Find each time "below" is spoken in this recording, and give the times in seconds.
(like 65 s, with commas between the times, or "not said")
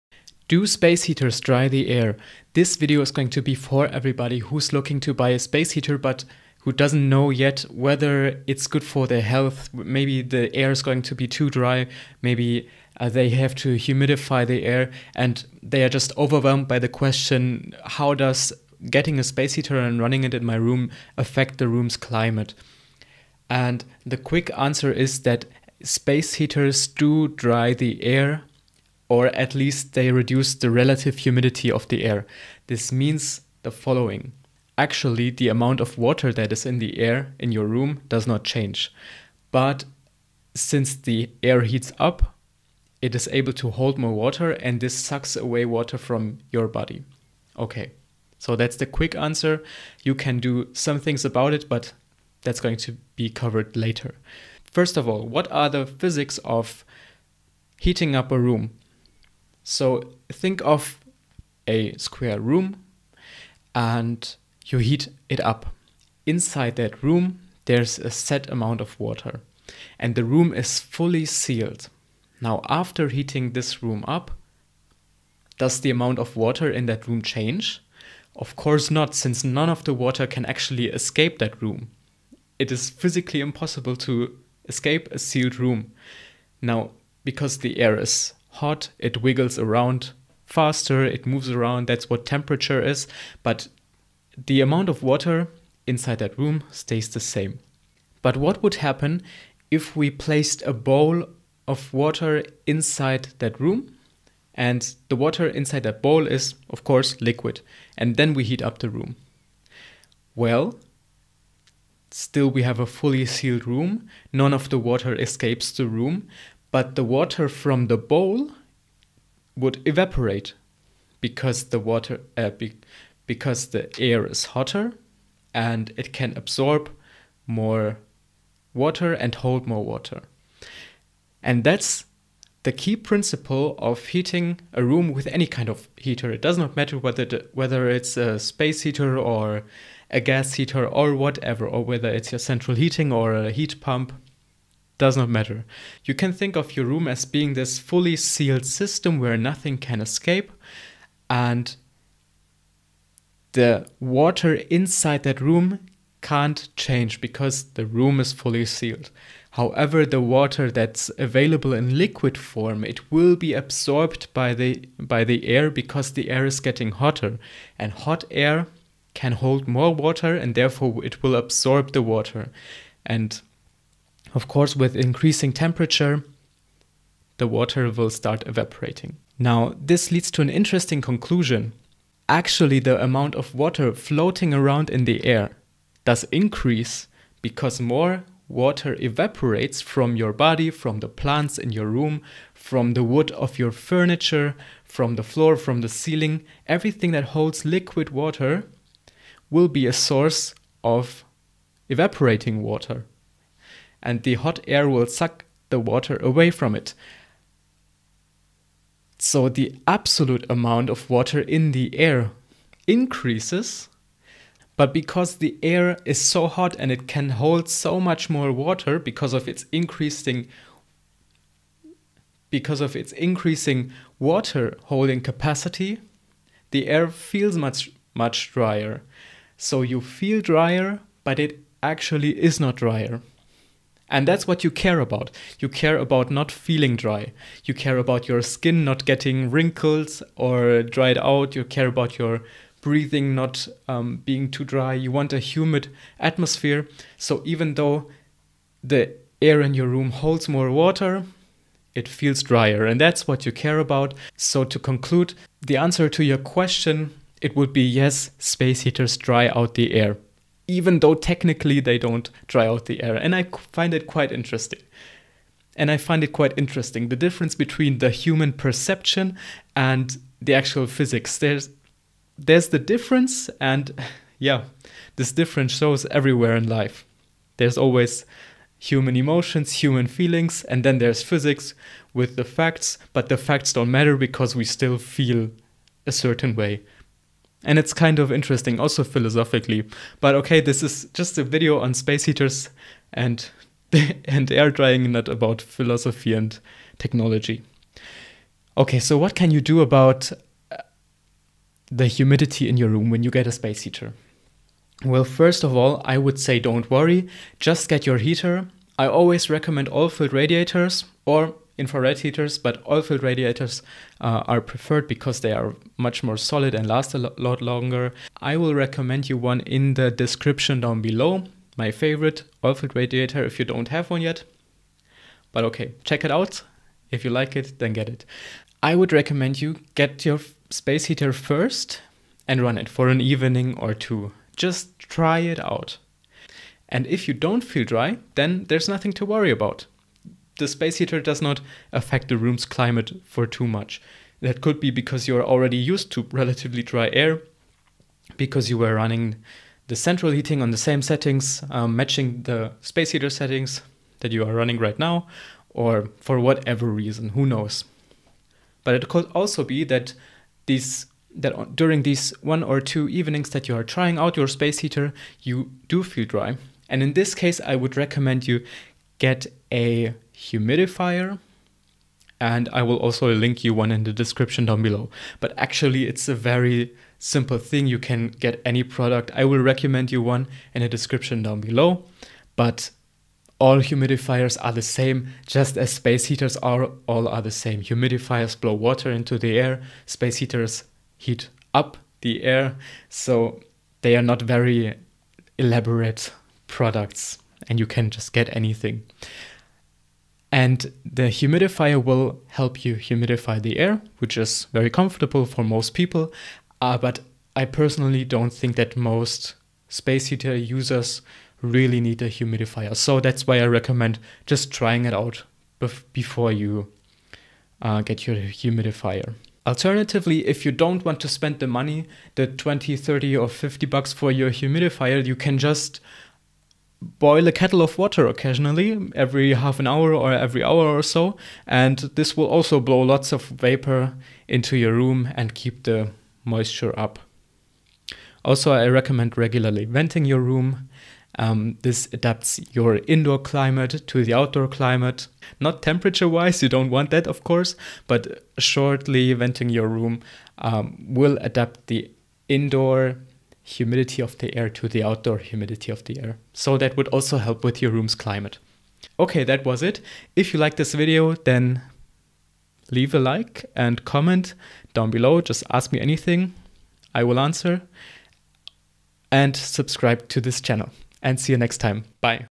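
321 s, 374 s, 381 s, 465 s.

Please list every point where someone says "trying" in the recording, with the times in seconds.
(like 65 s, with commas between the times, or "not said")
363 s, 414 s.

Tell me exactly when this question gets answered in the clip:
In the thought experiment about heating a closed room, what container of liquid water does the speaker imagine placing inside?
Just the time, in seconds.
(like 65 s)
100 s.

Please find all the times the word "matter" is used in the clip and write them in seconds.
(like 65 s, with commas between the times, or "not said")
136 s, 145 s, 283 s.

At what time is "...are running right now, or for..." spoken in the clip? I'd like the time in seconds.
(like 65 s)
354 s.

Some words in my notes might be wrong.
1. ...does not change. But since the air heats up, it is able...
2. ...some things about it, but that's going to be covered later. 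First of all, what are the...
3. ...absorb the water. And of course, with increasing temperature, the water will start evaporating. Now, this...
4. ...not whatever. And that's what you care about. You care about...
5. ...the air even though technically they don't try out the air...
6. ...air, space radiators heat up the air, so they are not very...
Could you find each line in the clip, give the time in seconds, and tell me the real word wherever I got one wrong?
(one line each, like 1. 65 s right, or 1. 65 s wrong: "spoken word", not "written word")
1. 38 s right
2. 50 s right
3. 171 s right
4. 232 s wrong: "drier", not "whatever"
5. 259 s right
6. 389 s wrong: "heaters", not "radiators".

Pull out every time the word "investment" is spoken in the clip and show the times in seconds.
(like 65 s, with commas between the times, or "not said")
not said.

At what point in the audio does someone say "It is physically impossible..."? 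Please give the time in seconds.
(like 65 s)
82 s.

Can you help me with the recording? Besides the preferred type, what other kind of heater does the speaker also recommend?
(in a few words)
Infrared heaters.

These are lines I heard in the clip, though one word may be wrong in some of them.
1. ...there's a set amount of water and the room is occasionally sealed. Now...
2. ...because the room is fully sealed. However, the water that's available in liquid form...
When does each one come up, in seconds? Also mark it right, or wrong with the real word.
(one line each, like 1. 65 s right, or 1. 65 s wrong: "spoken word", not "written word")
1. 67 s wrong: "fully", not "occasionally"
2. 157 s right.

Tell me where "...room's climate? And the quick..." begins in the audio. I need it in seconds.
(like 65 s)
21 s.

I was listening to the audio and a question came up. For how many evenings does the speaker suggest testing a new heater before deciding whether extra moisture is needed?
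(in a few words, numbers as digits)
One or two.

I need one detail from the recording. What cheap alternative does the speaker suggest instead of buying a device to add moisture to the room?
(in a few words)
Boil a kettle of water.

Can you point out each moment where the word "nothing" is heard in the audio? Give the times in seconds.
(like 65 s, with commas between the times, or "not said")
149 s, 338 s.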